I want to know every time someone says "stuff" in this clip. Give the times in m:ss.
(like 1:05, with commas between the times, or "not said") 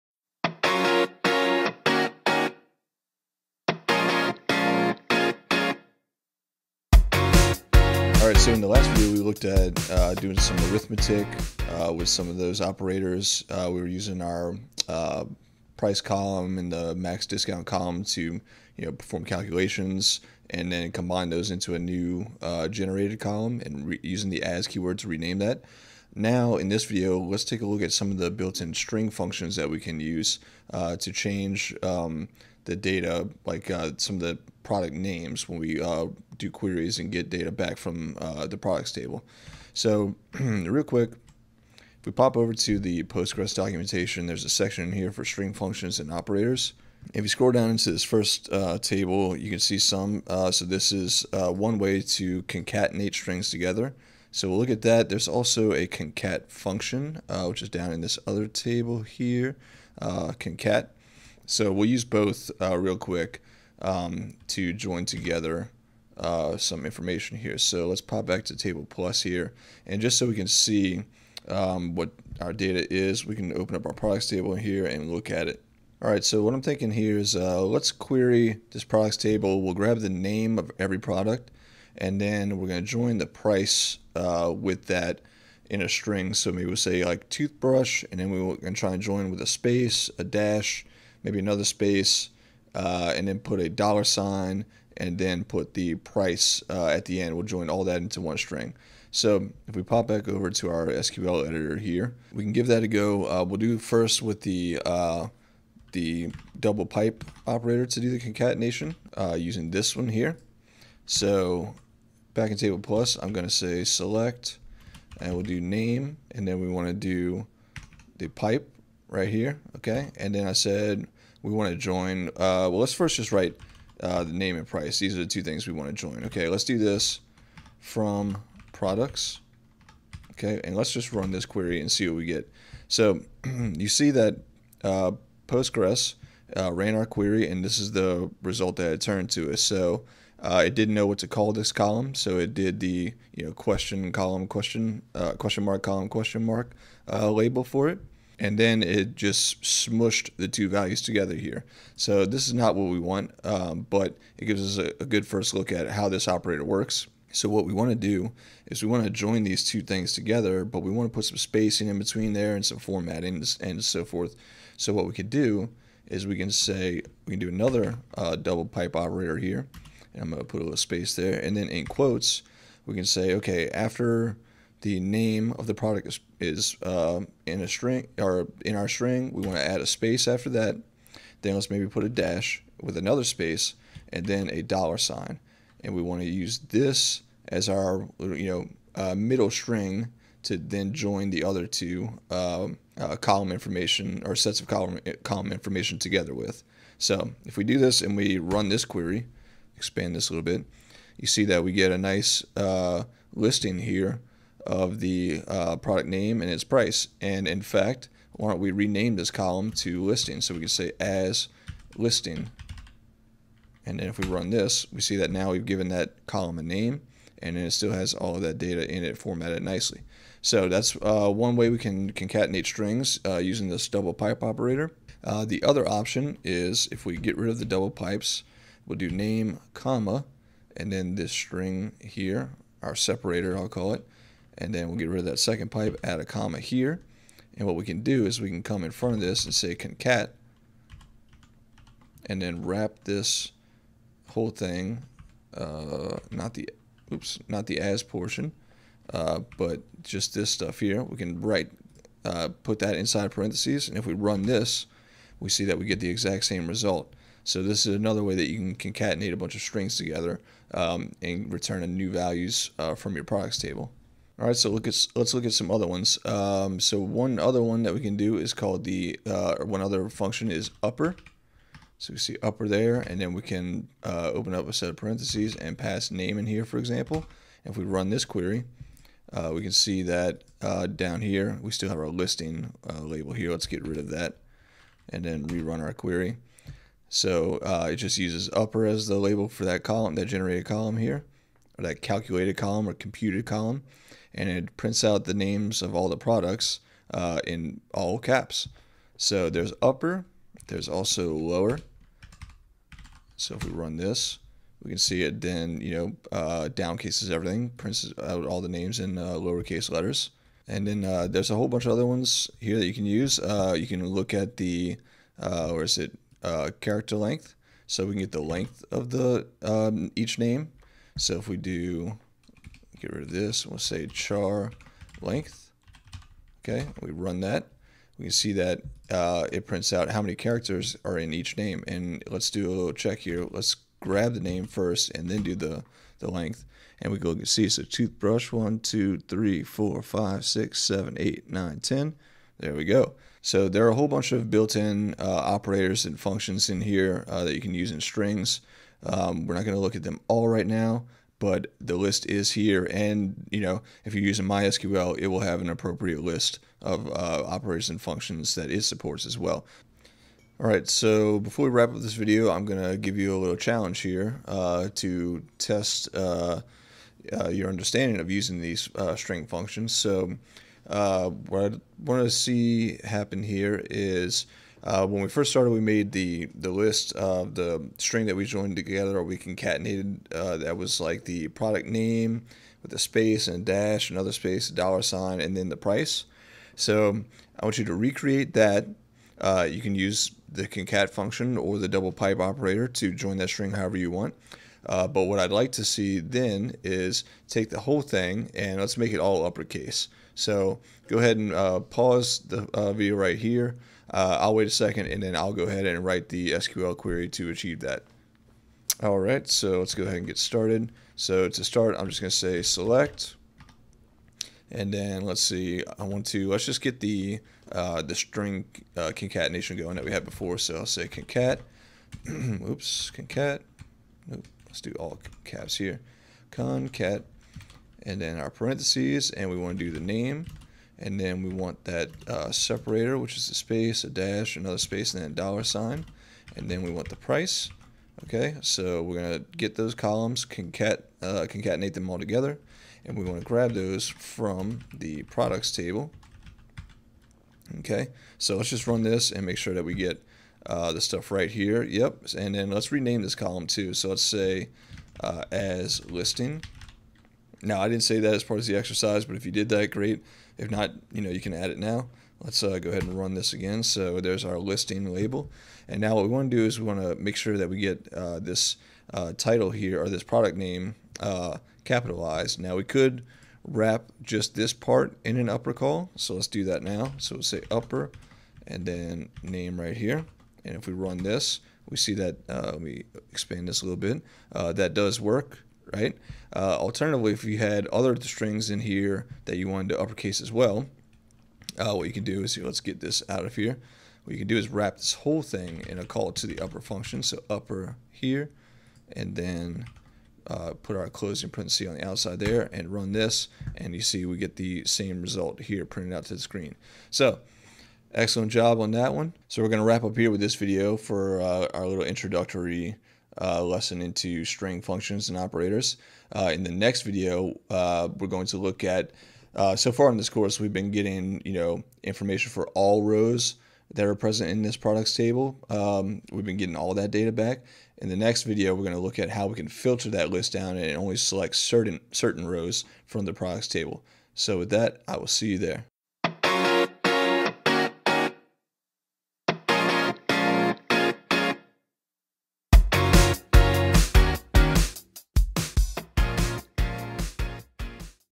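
4:10, 7:31.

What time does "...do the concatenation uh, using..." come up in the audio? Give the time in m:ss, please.
1:47.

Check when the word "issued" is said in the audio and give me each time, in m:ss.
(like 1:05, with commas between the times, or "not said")
not said.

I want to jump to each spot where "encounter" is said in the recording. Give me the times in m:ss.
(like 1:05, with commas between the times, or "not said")
not said.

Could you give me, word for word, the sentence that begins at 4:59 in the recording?
So there's upper, there's also lower.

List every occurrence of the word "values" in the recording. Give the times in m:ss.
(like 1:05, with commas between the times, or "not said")
2:30, 4:22.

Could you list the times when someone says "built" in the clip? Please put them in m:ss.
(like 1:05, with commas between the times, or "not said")
0:28, 5:44.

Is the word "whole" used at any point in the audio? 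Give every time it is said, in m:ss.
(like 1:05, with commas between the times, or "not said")
4:04, 5:11, 5:43, 6:37, 8:15.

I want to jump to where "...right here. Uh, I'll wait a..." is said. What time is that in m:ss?
6:43.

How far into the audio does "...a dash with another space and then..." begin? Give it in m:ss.
3:02.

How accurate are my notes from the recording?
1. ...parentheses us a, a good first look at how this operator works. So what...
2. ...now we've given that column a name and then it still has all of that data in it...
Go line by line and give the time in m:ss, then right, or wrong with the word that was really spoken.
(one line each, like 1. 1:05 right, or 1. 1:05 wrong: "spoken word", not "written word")
1. 2:34 wrong: "gives", not "parentheses"
2. 3:35 right.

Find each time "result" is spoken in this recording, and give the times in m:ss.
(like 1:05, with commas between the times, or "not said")
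2:18, 4:16, 8:25.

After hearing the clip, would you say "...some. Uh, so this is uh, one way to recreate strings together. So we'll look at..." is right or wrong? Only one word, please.
wrong.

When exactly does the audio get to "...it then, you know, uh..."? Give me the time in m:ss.
5:05.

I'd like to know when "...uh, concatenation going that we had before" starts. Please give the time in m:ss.
6:58.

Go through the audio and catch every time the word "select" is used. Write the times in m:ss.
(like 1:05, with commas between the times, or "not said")
1:53, 6:52, 8:51.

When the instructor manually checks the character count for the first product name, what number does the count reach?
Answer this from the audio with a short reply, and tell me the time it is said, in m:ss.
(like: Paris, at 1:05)
10, at 5:41.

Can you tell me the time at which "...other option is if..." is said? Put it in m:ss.
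3:45.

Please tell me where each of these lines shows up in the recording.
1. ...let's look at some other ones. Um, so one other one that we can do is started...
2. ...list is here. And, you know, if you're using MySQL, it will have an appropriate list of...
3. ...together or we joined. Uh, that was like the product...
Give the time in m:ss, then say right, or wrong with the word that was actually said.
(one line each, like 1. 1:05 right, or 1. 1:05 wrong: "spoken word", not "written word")
1. 4:25 wrong: "called", not "started"
2. 5:51 right
3. 6:18 wrong: "concatenated", not "joined".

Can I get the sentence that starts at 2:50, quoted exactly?
And I'm going to put a little space there.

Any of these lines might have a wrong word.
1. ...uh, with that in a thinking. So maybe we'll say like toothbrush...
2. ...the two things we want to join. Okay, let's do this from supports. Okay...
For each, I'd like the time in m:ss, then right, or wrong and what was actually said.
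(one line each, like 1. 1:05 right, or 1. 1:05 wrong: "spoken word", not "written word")
1. 1:24 wrong: "string", not "thinking"
2. 2:05 wrong: "products", not "supports".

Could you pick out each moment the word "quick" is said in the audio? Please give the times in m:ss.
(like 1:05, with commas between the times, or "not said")
0:40, 1:02.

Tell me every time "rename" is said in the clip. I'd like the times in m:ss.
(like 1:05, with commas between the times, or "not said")
0:25, 3:28, 7:32.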